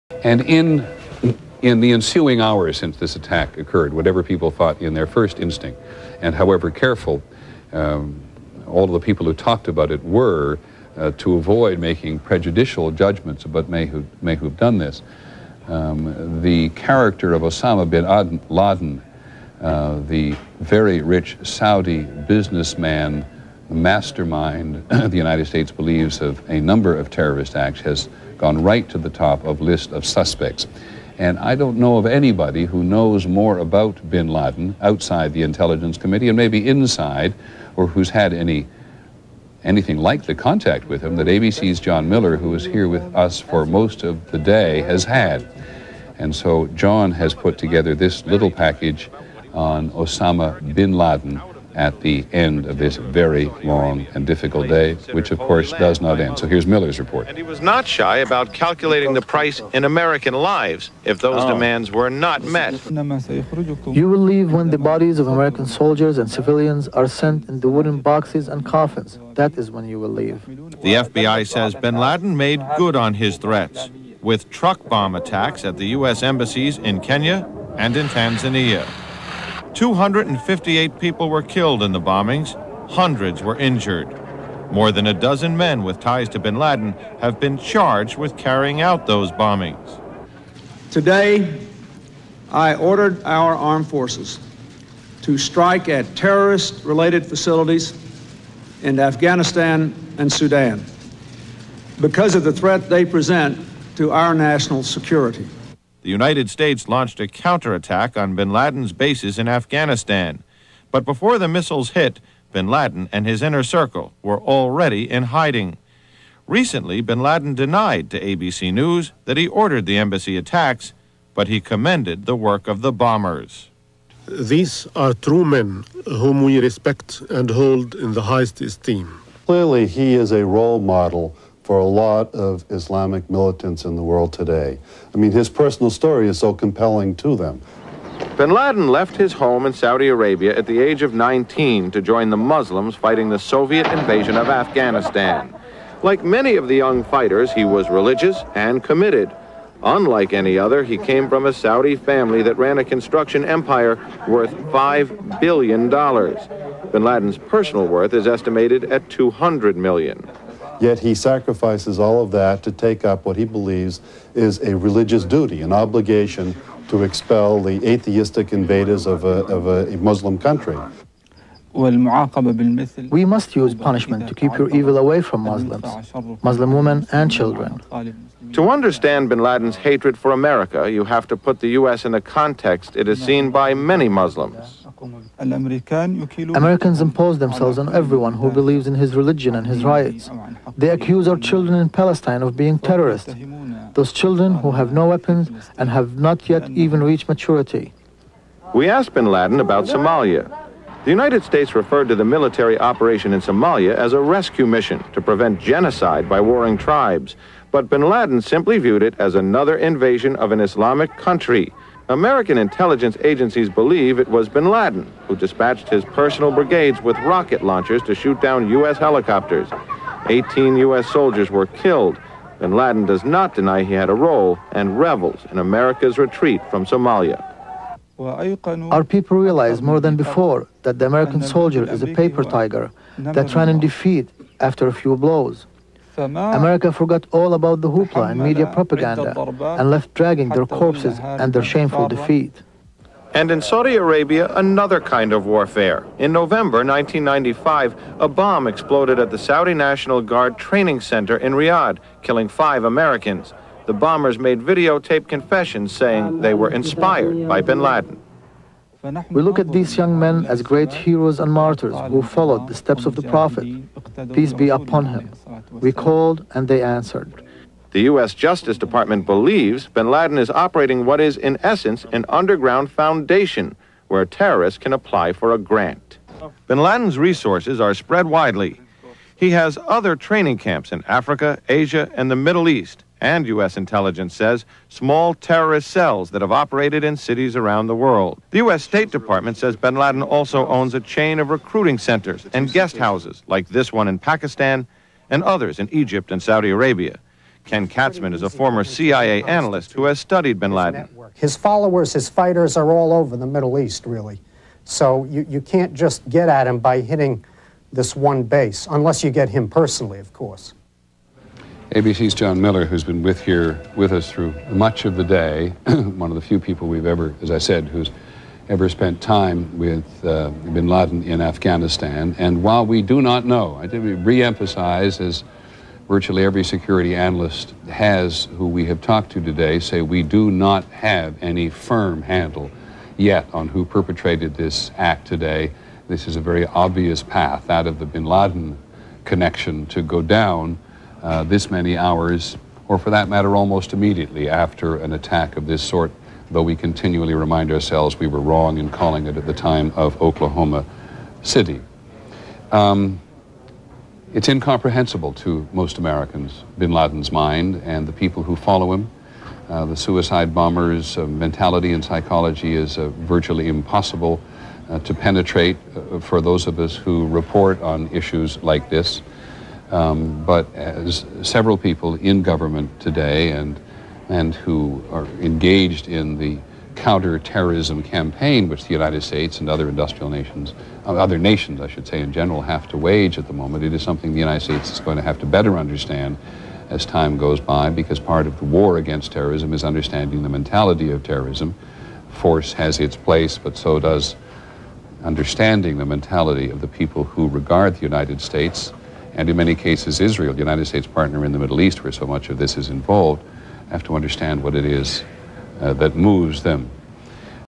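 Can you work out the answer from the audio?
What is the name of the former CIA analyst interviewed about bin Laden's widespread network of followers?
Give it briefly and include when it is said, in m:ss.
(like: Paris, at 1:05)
Ken Katzman, at 4:57.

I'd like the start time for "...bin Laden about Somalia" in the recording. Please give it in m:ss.
3:19.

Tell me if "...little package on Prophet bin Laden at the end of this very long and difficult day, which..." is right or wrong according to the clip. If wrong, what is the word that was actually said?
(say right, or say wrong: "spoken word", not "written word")
wrong: "Osama", not "Prophet".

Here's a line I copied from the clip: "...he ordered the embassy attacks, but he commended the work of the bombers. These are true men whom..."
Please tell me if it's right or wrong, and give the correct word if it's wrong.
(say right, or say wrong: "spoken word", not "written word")
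right.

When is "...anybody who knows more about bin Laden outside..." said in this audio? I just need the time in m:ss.
0:32.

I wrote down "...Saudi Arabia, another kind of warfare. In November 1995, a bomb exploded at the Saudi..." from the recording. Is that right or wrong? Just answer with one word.
right.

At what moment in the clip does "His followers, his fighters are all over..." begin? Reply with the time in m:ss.
5:01.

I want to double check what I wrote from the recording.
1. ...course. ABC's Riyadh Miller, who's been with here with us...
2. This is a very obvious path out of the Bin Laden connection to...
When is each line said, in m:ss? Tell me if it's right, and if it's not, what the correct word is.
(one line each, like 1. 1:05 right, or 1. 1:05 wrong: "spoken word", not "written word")
1. 5:10 wrong: "John", not "Riyadh"
2. 5:36 right.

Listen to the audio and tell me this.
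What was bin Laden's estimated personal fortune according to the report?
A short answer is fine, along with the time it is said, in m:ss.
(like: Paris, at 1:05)
200 million, at 2:39.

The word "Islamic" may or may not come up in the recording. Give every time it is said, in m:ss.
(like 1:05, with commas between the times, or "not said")
2:12, 3:30.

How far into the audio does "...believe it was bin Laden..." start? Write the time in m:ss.
3:33.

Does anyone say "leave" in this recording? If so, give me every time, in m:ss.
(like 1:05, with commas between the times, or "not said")
1:04, 1:10.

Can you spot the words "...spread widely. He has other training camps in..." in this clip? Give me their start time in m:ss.
4:37.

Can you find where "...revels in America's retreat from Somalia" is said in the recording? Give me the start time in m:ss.
3:44.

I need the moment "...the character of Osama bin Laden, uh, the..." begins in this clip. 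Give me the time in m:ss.
0:16.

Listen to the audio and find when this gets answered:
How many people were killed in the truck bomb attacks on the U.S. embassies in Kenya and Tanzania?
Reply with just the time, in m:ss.
1:19.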